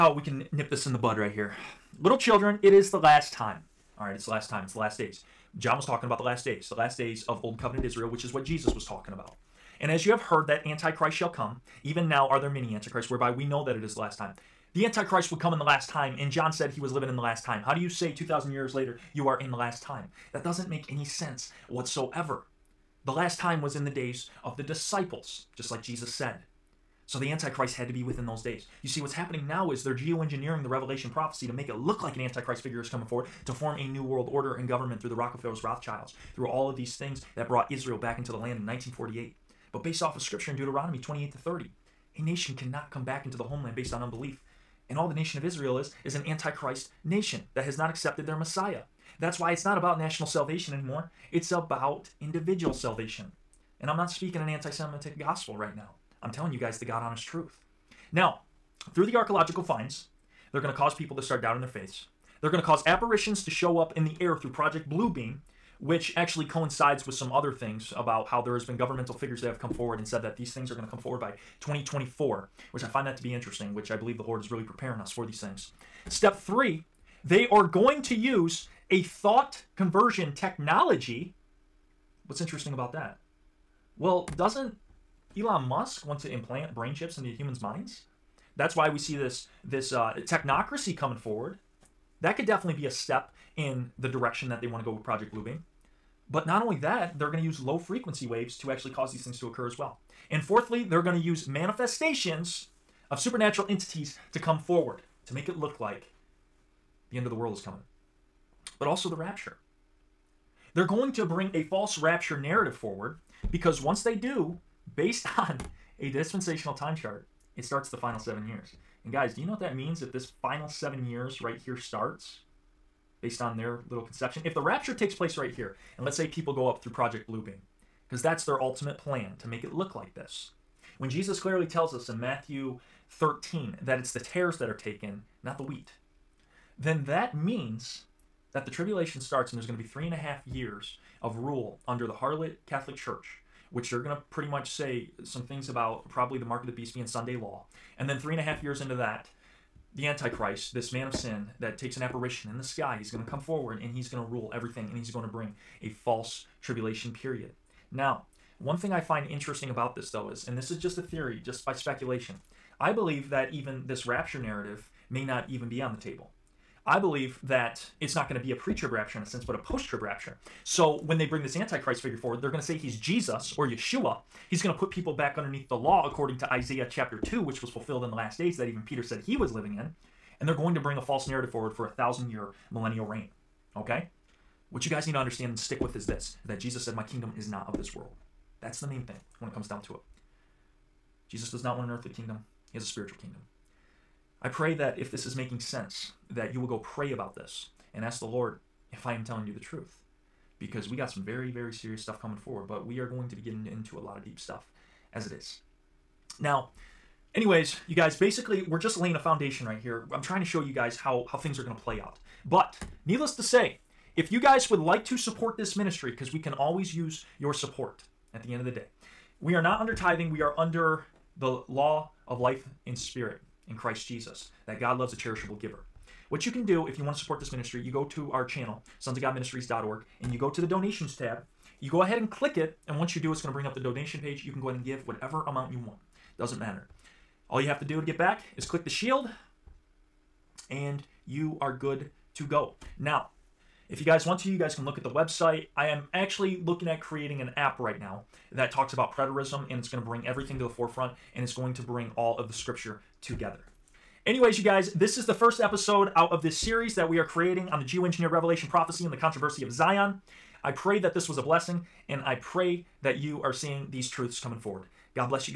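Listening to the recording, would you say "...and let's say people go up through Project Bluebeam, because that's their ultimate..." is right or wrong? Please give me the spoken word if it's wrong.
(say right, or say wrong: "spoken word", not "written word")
right.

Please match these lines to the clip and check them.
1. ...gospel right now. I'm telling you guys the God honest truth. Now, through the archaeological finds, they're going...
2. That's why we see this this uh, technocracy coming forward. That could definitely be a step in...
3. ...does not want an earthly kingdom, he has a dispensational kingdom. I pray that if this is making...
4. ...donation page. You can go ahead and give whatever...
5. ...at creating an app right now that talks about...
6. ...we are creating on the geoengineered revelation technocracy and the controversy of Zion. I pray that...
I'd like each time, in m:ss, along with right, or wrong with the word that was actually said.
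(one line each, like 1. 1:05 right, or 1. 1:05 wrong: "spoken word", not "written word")
1. 0:55 right
2. 1:28 right
3. 3:11 wrong: "spiritual", not "dispensational"
4. 3:53 right
5. 4:06 right
6. 4:17 wrong: "prophecy", not "technocracy".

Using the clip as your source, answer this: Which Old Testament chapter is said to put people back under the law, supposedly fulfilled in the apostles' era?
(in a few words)
Isaiah 2.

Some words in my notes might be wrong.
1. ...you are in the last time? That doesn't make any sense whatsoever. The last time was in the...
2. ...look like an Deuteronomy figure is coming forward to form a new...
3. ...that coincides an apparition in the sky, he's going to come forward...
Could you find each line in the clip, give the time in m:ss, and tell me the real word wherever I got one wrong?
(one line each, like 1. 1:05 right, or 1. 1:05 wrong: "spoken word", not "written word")
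1. 0:19 right
2. 0:31 wrong: "Antichrist", not "Deuteronomy"
3. 2:31 wrong: "takes", not "coincides".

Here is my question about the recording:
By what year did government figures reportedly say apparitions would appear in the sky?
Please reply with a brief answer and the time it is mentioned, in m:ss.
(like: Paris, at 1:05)
2024, at 1:11.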